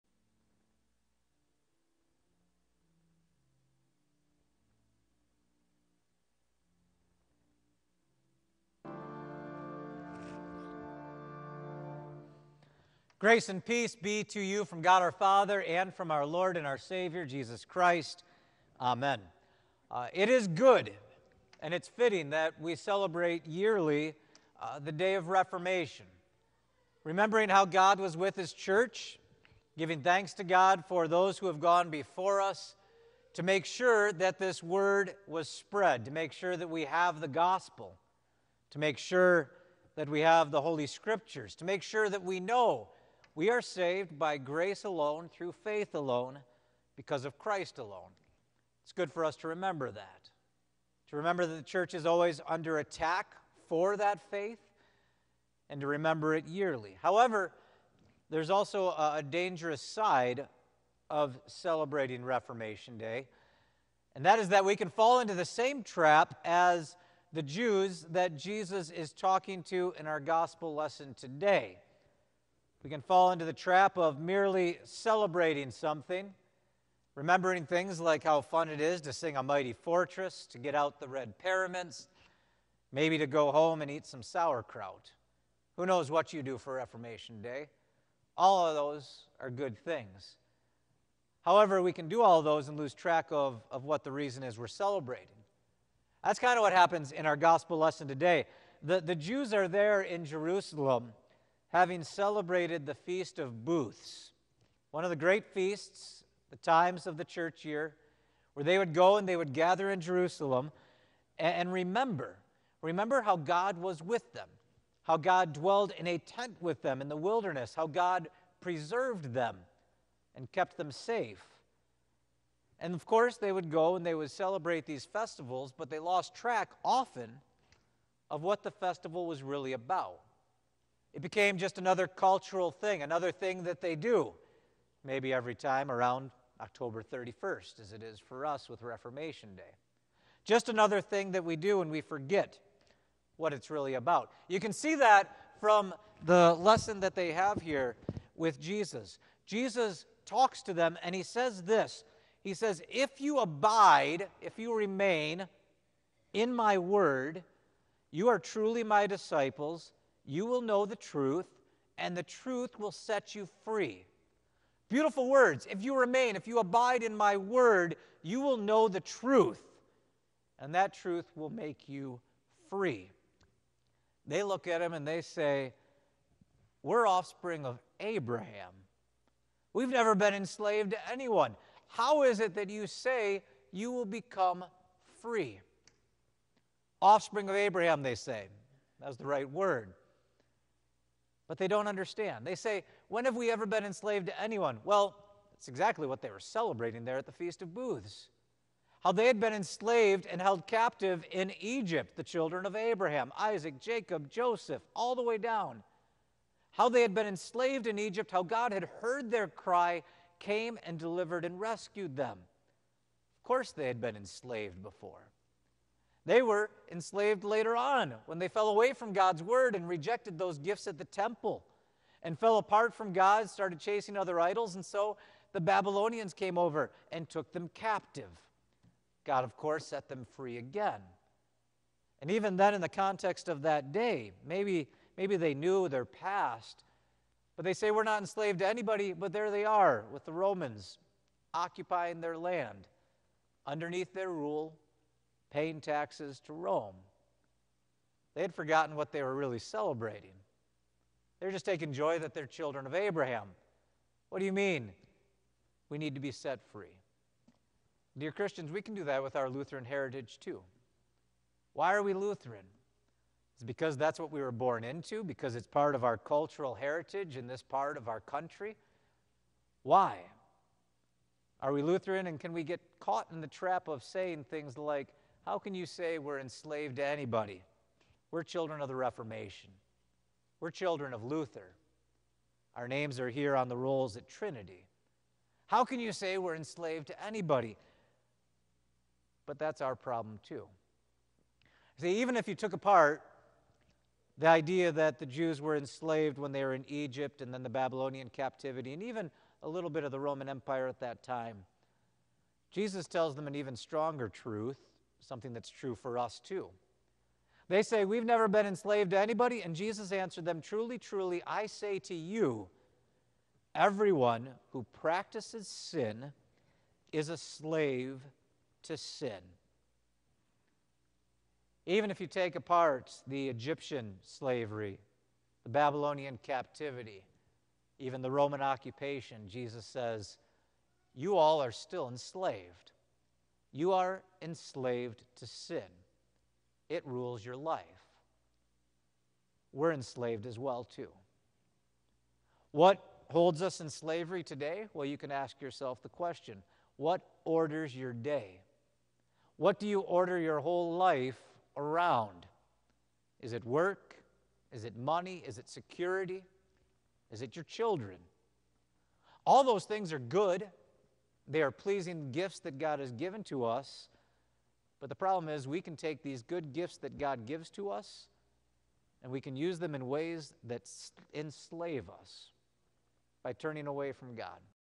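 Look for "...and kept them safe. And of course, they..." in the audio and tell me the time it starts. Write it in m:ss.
2:00.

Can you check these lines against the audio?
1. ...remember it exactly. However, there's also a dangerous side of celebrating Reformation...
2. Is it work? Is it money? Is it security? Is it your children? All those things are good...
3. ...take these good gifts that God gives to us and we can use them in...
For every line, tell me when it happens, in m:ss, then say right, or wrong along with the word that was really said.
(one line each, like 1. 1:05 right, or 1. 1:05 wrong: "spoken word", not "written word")
1. 0:55 wrong: "yearly", not "exactly"
2. 5:53 right
3. 6:05 right.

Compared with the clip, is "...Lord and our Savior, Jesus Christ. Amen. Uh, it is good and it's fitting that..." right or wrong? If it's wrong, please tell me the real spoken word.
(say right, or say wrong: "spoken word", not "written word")
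right.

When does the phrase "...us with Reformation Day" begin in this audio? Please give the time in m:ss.
2:18.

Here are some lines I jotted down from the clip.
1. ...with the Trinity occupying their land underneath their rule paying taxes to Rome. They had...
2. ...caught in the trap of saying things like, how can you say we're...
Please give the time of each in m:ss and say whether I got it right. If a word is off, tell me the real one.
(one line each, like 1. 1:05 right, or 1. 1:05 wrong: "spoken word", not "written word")
1. 4:00 wrong: "Romans", not "Trinity"
2. 4:32 right.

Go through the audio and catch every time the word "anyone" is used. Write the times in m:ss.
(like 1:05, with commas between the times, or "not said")
3:01, 3:14.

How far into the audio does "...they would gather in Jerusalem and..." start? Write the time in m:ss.
1:49.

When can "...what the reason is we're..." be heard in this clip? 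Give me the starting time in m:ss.
1:33.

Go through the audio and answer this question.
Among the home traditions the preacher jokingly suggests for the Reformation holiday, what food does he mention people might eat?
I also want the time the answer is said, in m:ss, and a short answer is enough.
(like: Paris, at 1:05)
sauerkraut, at 1:24.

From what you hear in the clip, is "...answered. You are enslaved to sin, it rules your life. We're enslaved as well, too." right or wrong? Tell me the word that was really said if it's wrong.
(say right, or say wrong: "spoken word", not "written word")
wrong: "enslaved", not "answered".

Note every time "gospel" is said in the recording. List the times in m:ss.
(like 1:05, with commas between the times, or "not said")
0:37, 1:10, 1:37.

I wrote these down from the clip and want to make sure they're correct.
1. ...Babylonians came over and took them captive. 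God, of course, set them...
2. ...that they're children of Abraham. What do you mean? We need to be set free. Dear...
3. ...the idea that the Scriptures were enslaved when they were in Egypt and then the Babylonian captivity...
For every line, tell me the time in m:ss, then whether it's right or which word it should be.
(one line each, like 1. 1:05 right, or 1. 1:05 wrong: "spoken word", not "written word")
1. 3:45 right
2. 4:12 right
3. 4:54 wrong: "Jews", not "Scriptures".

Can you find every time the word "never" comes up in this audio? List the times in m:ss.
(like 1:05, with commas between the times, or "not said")
2:59, 5:08.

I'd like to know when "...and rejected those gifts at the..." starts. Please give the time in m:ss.
3:39.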